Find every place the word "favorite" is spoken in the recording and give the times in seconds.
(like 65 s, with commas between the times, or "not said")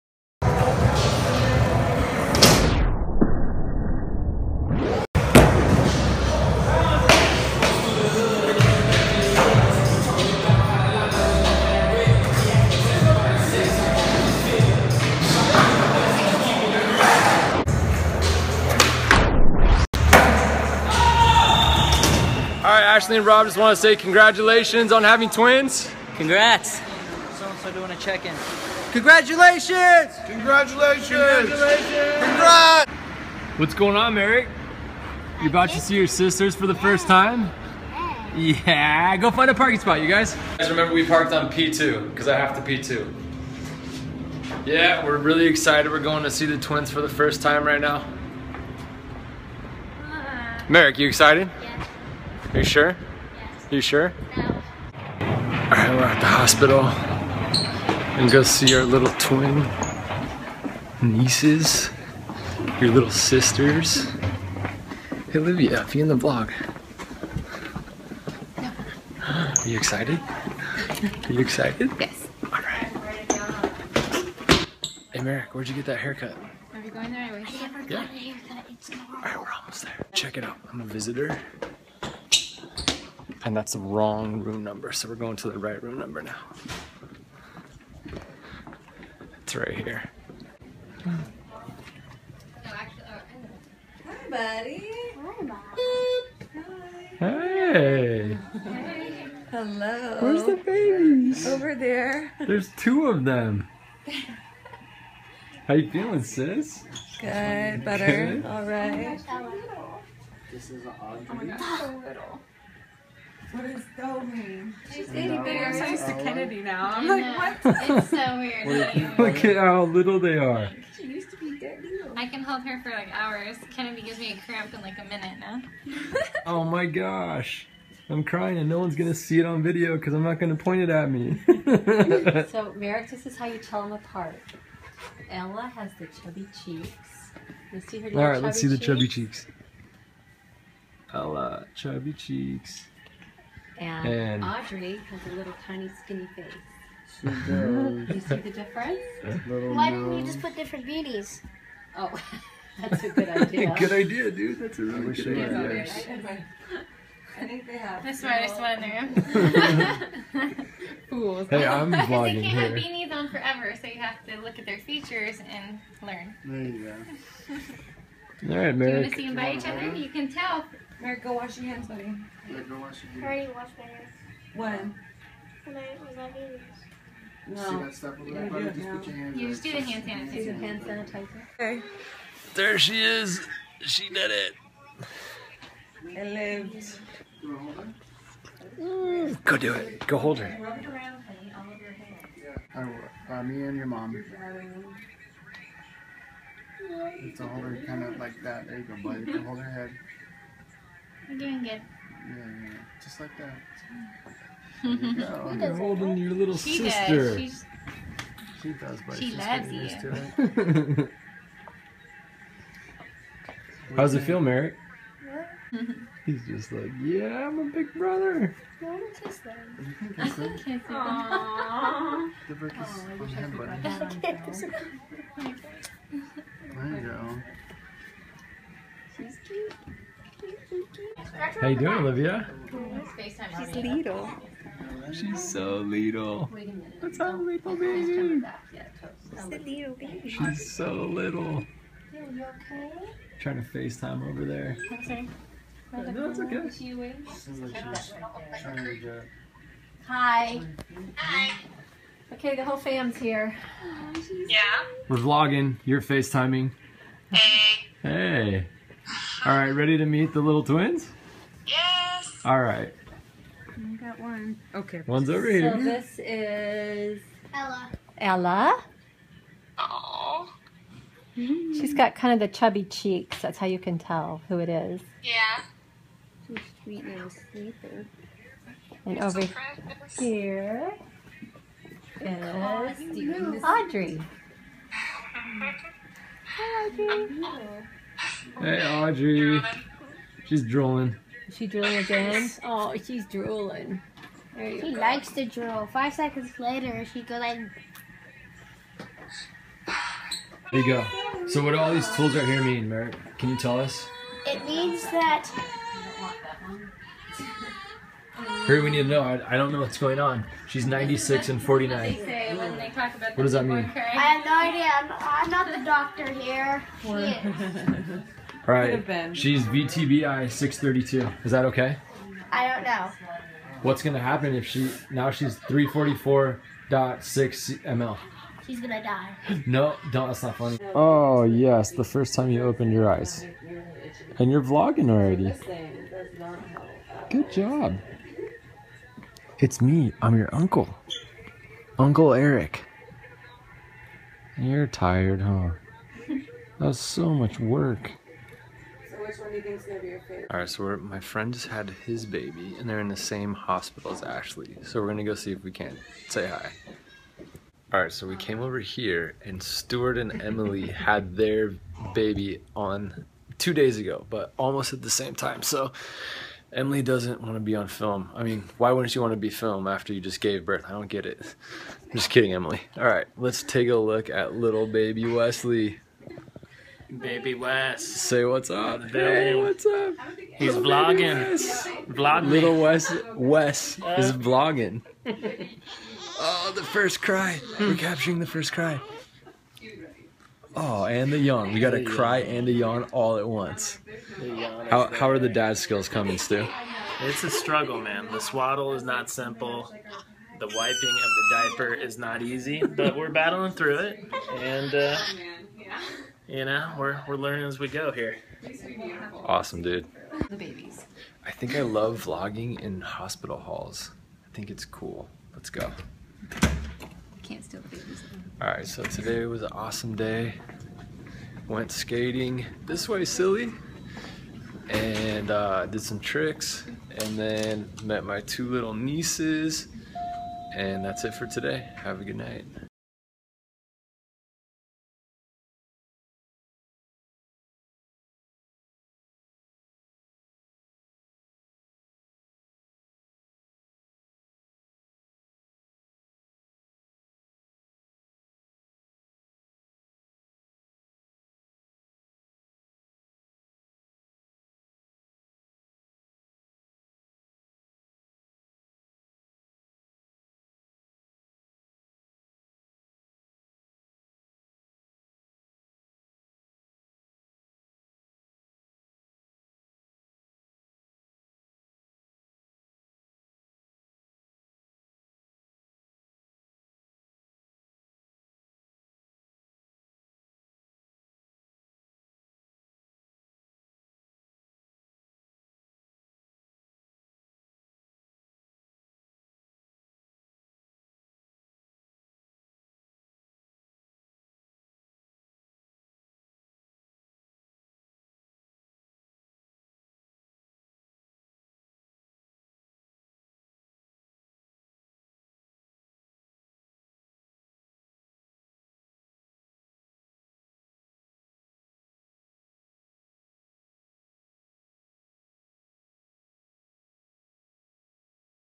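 350 s.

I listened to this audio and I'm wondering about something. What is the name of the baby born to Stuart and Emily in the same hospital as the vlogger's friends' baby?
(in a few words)
Wesley.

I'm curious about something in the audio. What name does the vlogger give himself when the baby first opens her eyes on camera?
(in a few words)
Uncle Eric.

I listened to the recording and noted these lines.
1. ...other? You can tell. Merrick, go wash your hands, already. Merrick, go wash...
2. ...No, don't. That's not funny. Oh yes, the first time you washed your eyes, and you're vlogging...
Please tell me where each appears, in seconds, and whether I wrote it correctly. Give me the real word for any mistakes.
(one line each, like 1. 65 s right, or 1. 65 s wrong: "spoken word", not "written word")
1. 169 s wrong: "buddy", not "already"
2. 329 s wrong: "opened", not "washed".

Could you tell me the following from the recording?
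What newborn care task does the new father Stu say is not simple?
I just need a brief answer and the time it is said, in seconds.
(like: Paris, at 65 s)
The swaddle, at 398 s.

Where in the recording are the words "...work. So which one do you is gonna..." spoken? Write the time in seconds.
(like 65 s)
347 s.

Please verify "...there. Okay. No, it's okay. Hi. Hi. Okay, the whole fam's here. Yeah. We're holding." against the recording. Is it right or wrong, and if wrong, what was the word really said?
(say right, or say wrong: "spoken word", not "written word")
wrong: "vlogging", not "holding".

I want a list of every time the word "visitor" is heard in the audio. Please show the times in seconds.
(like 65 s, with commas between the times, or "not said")
80 s.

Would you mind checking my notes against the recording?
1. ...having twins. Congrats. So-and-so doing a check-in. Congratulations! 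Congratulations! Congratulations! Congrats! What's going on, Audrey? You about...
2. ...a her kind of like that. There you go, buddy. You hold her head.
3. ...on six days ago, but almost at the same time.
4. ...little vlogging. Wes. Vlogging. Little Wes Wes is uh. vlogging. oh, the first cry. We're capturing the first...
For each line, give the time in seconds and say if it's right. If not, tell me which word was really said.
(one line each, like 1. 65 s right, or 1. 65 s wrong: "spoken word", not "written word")
1. 25 s wrong: "Eric", not "Audrey"
2. 197 s right
3. 362 s wrong: "two", not "six"
4. 380 s right.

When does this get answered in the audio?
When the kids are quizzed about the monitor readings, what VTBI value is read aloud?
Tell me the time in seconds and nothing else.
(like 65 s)
319 s.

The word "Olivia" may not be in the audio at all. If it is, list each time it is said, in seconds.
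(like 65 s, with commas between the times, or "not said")
65 s, 231 s.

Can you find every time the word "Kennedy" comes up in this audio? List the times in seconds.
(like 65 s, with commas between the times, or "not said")
116 s, 123 s.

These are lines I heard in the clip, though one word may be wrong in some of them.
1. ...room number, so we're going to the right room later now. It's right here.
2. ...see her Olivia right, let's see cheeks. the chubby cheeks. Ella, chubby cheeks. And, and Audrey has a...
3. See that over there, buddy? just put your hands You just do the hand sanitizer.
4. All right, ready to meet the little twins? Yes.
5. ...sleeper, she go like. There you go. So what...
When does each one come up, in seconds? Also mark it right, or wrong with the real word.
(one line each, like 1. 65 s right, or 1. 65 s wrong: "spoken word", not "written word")
1. 84 s wrong: "number", not "later"
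2. 137 s wrong: "All", not "Olivia"
3. 177 s right
4. 259 s right
5. 296 s wrong: "later", not "sleeper".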